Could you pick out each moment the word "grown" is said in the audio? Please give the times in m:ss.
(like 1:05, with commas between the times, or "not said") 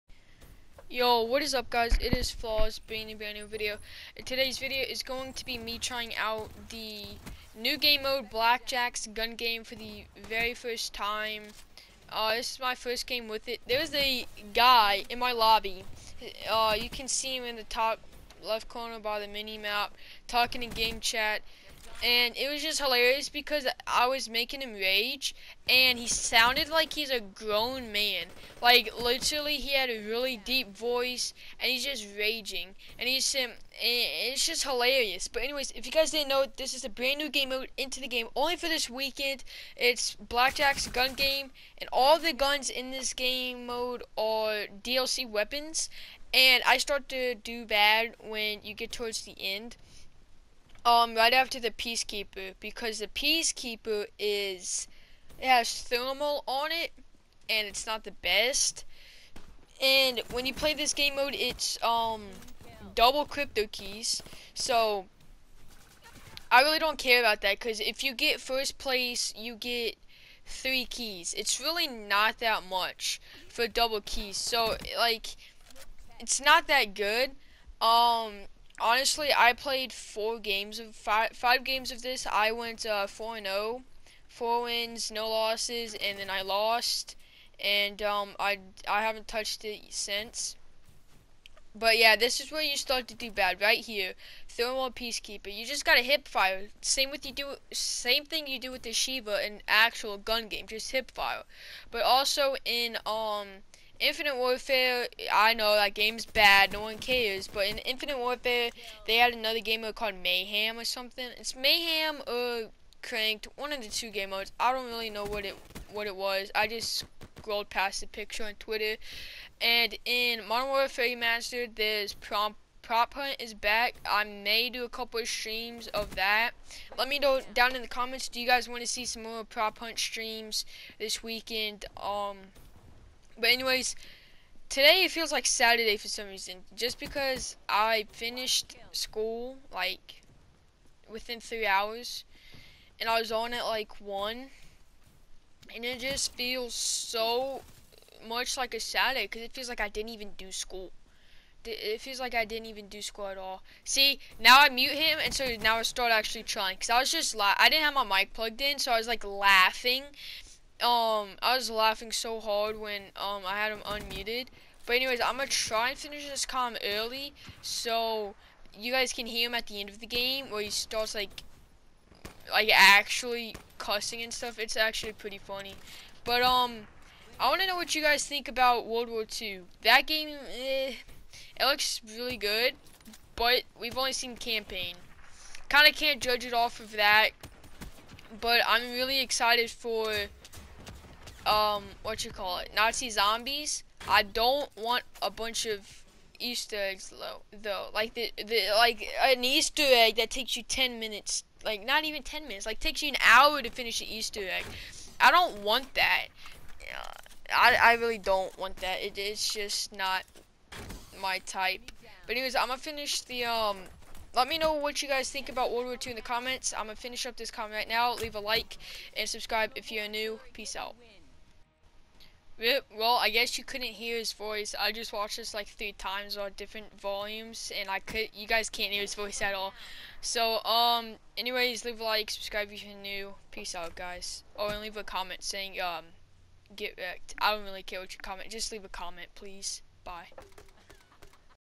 0:27.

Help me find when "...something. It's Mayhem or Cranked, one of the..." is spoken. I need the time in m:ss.
1:50.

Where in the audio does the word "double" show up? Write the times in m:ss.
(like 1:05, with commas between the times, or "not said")
1:02, 1:13.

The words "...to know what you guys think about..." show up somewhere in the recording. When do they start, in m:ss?
2:57.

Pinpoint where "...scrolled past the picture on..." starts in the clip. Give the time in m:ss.
1:57.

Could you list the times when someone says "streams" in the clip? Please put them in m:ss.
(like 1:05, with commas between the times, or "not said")
2:05, 2:09.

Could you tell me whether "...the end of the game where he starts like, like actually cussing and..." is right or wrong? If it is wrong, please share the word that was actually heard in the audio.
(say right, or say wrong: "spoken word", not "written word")
right.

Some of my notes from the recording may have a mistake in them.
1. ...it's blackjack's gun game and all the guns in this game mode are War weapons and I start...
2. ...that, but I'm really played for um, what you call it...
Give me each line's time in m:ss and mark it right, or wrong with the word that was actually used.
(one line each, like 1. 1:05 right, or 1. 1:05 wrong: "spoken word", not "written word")
1. 0:39 wrong: "DLC", not "War"
2. 3:06 wrong: "excited", not "played".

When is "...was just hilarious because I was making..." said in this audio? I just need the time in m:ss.
0:22.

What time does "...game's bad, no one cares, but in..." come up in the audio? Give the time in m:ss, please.
1:45.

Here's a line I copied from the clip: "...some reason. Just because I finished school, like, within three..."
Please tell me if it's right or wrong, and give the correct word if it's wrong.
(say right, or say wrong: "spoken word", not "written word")
right.